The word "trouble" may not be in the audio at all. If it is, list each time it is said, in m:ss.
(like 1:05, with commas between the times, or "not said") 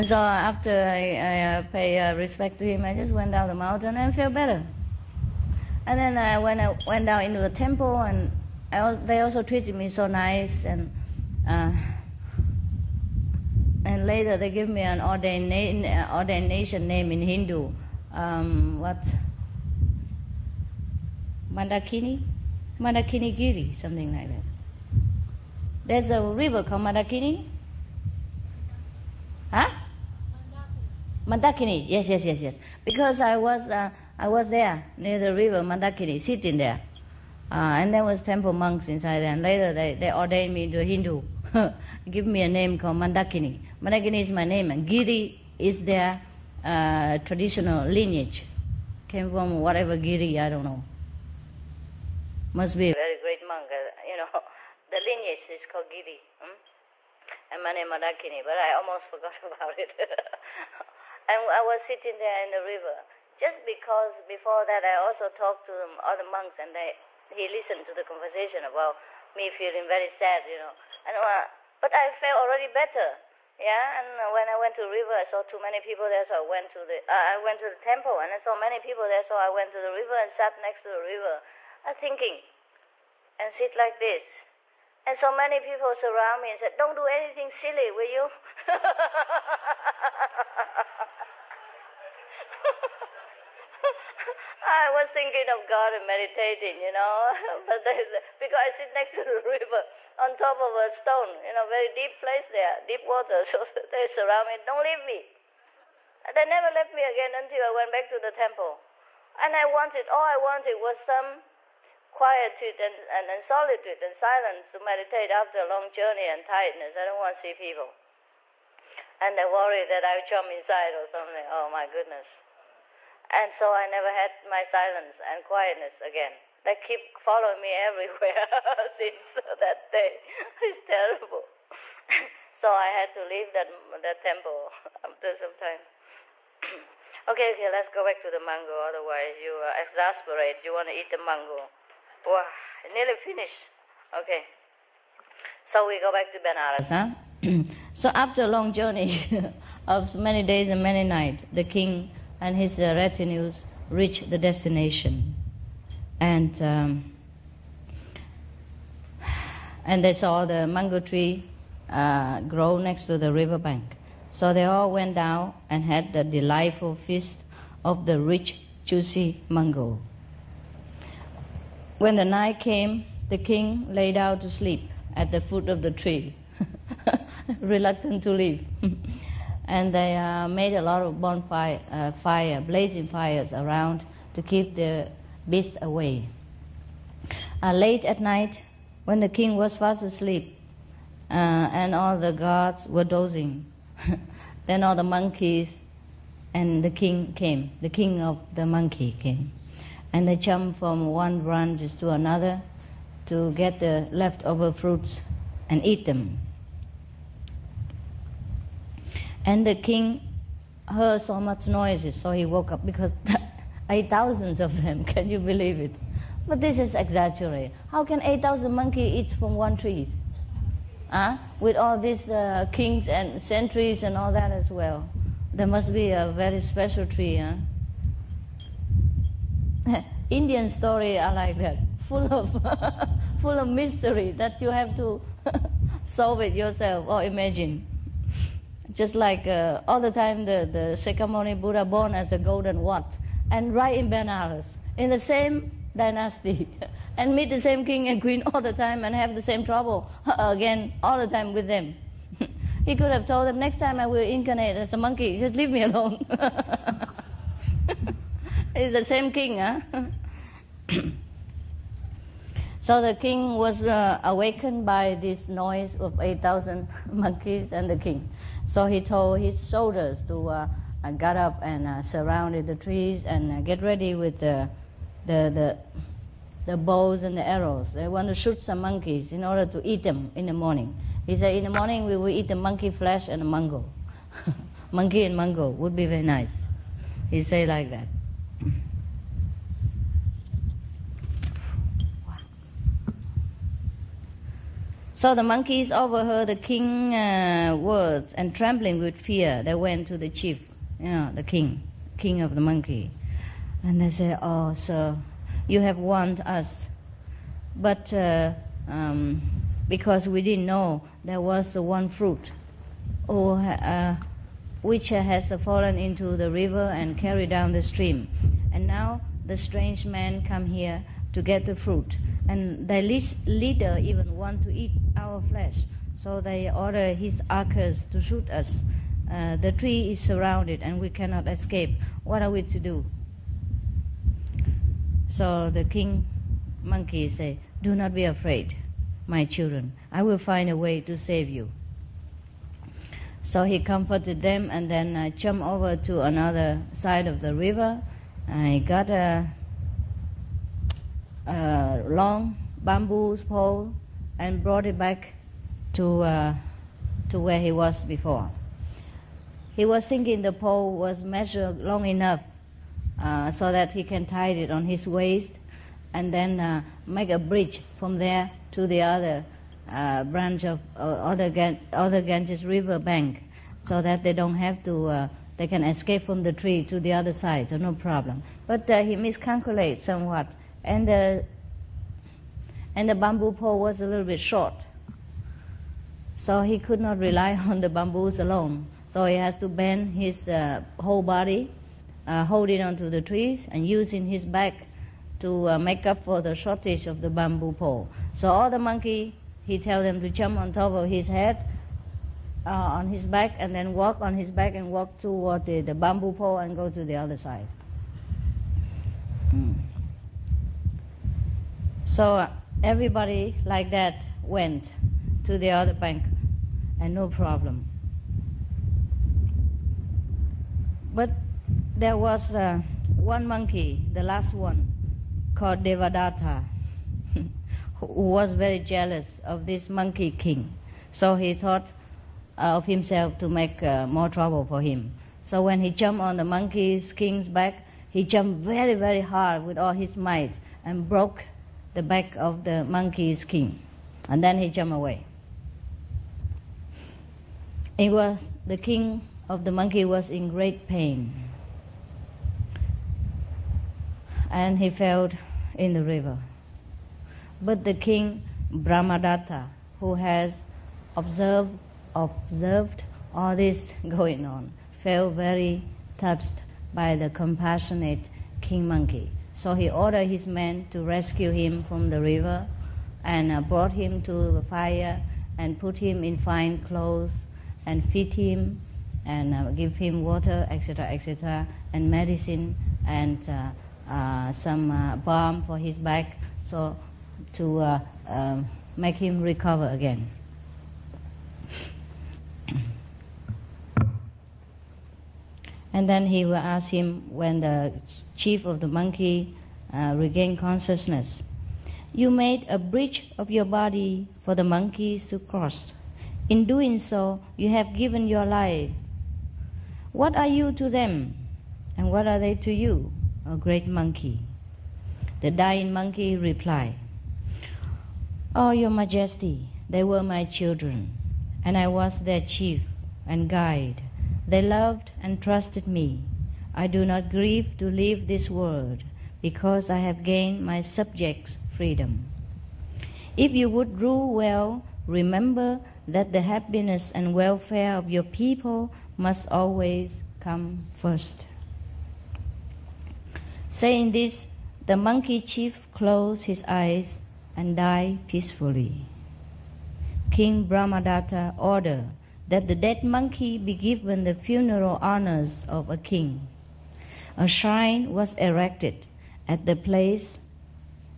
4:09, 7:14.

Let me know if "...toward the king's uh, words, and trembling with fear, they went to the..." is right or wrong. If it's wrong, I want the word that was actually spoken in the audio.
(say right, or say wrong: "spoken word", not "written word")
wrong: "overheard", not "toward".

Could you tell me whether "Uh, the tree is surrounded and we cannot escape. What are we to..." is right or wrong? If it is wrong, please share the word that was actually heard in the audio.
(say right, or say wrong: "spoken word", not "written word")
right.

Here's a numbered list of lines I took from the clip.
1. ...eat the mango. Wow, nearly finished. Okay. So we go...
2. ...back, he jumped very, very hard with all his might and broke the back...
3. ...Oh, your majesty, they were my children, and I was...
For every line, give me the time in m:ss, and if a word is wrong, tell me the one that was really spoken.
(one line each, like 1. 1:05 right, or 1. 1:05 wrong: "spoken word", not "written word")
1. 2:20 right
2. 7:17 right
3. 8:38 right.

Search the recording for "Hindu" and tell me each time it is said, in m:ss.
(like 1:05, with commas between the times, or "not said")
0:17, 0:40.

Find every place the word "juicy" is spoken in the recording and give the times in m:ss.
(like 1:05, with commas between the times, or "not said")
2:48.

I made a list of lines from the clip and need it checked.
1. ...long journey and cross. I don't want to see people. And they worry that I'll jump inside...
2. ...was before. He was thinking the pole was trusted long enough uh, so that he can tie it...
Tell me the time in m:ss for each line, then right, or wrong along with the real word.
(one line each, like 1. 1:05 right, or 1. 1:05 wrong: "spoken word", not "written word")
1. 1:55 wrong: "tiredness", not "cross"
2. 5:57 wrong: "measured", not "trusted".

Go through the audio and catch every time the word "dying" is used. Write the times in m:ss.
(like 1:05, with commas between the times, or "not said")
8:35.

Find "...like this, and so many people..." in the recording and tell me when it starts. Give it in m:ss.
1:23.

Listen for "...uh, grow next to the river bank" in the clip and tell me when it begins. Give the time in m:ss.
2:41.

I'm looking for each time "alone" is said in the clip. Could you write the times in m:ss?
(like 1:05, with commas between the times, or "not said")
4:15, 6:28.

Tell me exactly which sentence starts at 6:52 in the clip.
So everybody like that went to the other bank and no problem.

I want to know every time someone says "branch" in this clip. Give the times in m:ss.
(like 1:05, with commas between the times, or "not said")
3:21, 6:10.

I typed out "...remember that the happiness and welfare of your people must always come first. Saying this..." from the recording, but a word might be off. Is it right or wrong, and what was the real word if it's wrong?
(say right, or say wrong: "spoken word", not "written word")
right.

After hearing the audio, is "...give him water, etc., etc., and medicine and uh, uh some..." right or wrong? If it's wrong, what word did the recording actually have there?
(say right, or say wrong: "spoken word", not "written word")
right.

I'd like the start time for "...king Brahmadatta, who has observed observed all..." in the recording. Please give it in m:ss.
7:37.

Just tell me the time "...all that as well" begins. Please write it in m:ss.
3:44.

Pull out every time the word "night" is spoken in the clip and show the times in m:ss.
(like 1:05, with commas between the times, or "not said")
2:31, 2:52, 3:08.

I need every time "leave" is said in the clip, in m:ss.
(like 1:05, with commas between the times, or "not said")
1:44, 2:13, 2:58, 4:15, 8:47.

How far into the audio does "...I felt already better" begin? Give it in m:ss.
1:11.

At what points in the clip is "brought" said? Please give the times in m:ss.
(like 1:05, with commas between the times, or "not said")
5:54, 7:53.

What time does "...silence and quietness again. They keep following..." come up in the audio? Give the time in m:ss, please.
2:04.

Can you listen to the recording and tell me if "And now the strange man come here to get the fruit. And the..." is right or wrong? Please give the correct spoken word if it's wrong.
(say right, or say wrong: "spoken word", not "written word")
right.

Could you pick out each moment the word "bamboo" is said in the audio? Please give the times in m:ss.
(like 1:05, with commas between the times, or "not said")
5:52, 6:23, 6:27, 6:37, 6:45.